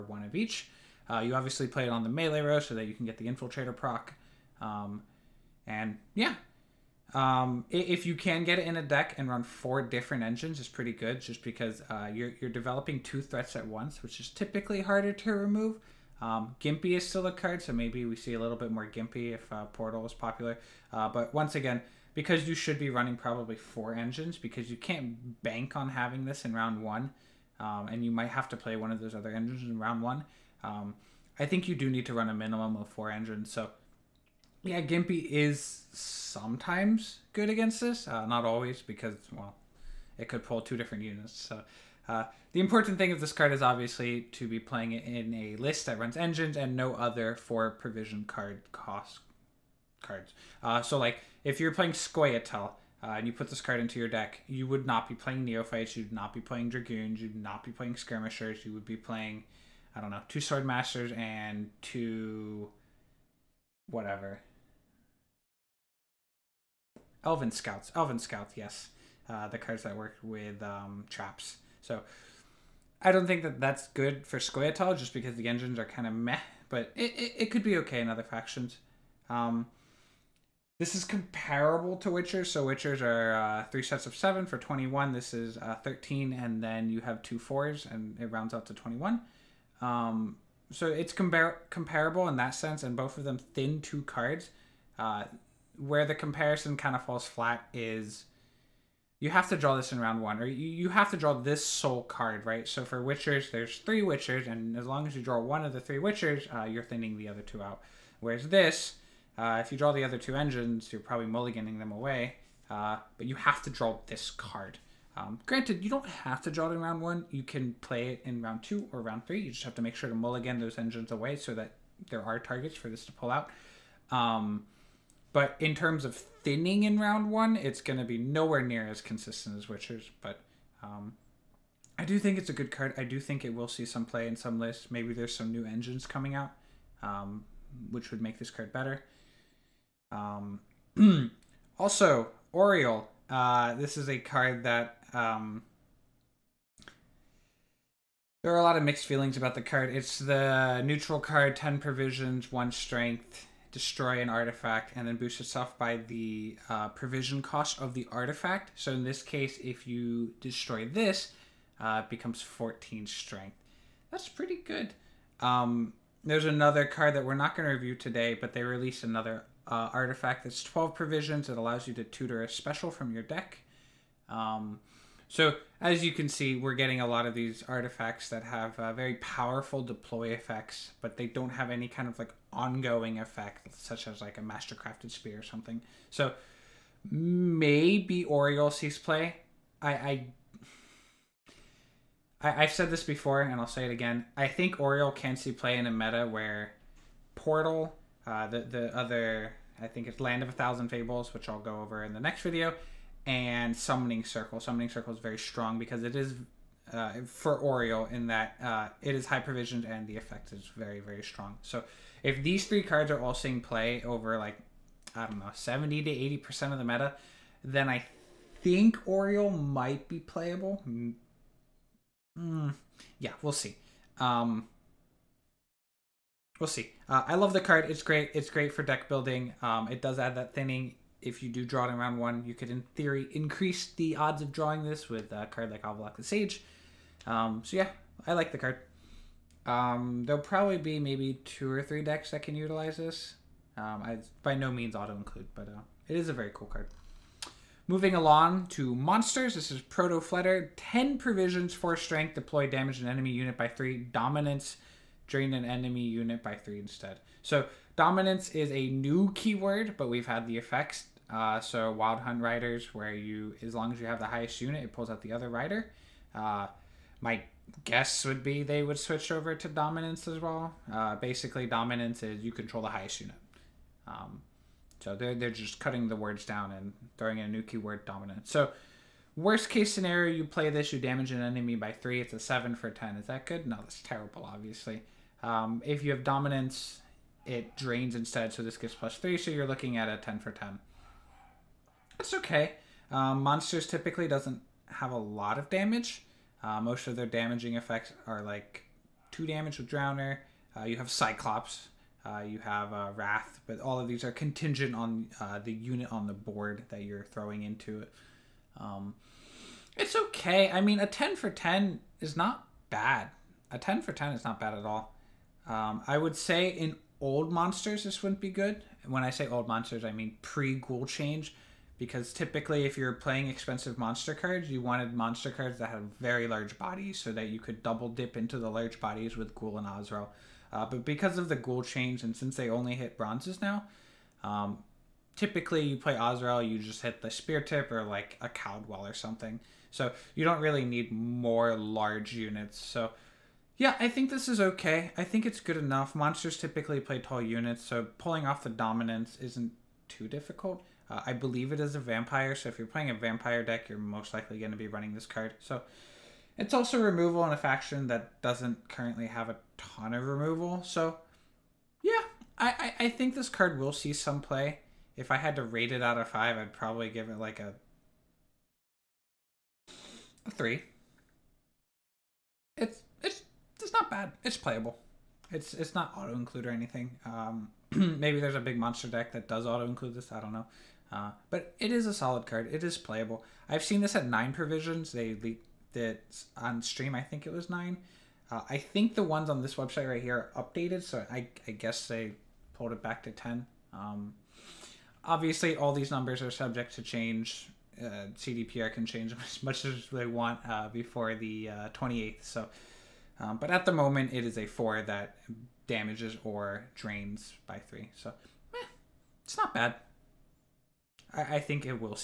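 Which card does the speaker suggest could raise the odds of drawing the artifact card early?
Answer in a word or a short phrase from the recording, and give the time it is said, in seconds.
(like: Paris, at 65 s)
Avallac'h the Sage, at 235 s.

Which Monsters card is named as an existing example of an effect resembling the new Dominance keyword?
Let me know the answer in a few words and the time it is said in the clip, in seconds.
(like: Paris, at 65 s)
Wild Hunt Riders, at 261 s.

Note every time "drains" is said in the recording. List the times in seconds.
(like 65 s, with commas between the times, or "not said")
255 s, 287 s, 406 s.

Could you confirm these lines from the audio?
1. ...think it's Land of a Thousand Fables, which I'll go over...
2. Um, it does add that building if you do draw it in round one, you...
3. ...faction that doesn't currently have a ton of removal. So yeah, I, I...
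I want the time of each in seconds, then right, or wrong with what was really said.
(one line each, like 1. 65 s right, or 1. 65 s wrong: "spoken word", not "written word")
1. 199 s right
2. 229 s wrong: "thinning", not "building"
3. 357 s right.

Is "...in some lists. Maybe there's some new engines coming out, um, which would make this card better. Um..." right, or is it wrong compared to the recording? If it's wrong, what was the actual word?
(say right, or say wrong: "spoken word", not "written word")
right.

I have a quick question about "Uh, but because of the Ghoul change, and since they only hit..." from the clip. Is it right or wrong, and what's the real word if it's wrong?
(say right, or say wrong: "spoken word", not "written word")
right.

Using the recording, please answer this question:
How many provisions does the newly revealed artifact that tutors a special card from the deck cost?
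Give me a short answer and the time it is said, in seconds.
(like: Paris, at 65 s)
12, at 170 s.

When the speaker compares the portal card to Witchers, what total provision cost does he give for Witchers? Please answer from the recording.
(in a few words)
21.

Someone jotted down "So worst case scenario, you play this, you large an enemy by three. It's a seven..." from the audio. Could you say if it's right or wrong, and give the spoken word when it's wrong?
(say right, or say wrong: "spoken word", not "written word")
wrong: "damage", not "large".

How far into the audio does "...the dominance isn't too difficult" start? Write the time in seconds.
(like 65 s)
348 s.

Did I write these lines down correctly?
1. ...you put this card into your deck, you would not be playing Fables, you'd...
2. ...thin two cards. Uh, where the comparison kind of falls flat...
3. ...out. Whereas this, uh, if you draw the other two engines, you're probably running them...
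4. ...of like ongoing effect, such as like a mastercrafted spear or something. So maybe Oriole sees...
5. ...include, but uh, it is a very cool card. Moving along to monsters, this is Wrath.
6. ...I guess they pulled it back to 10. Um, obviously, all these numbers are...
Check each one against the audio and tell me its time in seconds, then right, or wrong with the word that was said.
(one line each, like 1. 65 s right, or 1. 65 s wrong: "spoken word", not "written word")
1. 53 s wrong: "Neophytes", not "Fables"
2. 93 s right
3. 107 s wrong: "mulliganing", not "running"
4. 182 s right
5. 245 s wrong: "Protofleder", not "Wrath"
6. 391 s right.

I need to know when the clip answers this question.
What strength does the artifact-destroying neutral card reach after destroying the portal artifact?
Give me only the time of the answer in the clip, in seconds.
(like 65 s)
162 s.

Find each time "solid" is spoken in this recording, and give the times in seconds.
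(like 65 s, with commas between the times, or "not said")
382 s.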